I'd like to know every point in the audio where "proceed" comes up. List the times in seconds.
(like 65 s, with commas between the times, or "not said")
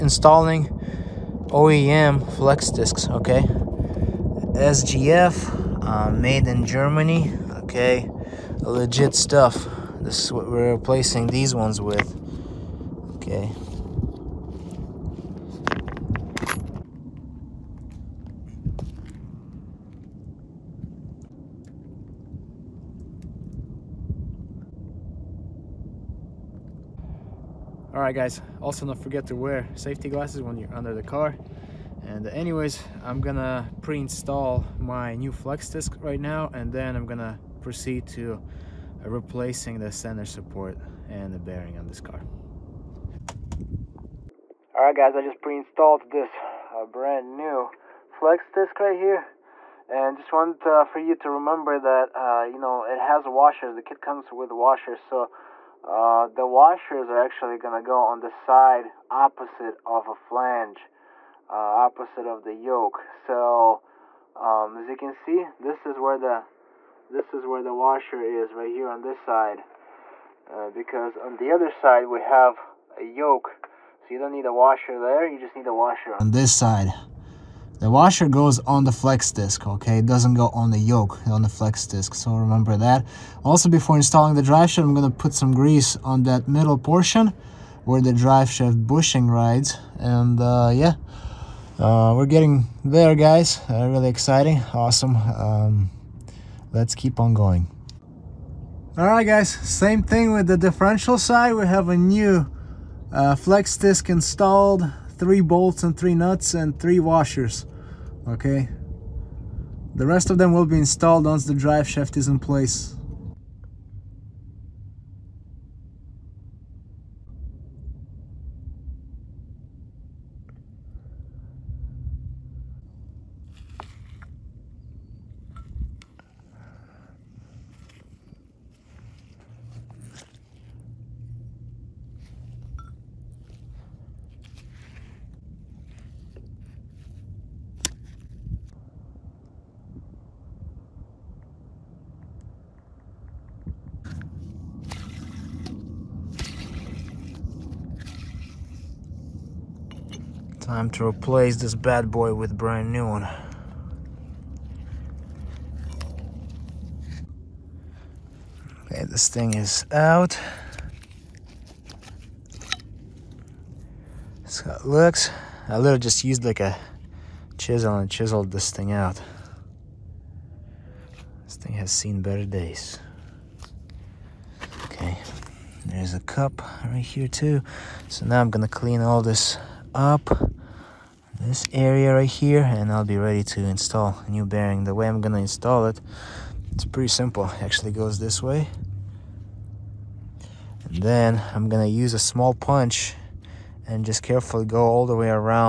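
37 s.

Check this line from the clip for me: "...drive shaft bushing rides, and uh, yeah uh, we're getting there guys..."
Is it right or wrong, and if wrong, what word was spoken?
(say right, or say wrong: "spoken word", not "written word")
right.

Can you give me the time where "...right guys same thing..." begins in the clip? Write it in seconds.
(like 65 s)
99 s.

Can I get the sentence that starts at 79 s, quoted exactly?
It doesn't go on the yoke, on the flex disc, so remember that.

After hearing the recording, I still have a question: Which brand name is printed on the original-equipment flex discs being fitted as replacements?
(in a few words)
SGF.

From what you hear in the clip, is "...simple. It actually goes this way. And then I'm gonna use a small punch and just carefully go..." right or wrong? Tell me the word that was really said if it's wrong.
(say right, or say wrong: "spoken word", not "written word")
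right.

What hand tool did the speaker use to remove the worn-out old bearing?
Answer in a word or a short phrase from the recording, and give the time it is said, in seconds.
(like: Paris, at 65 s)
a chisel, at 167 s.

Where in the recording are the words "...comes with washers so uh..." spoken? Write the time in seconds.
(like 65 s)
54 s.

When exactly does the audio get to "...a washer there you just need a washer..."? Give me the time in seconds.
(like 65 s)
74 s.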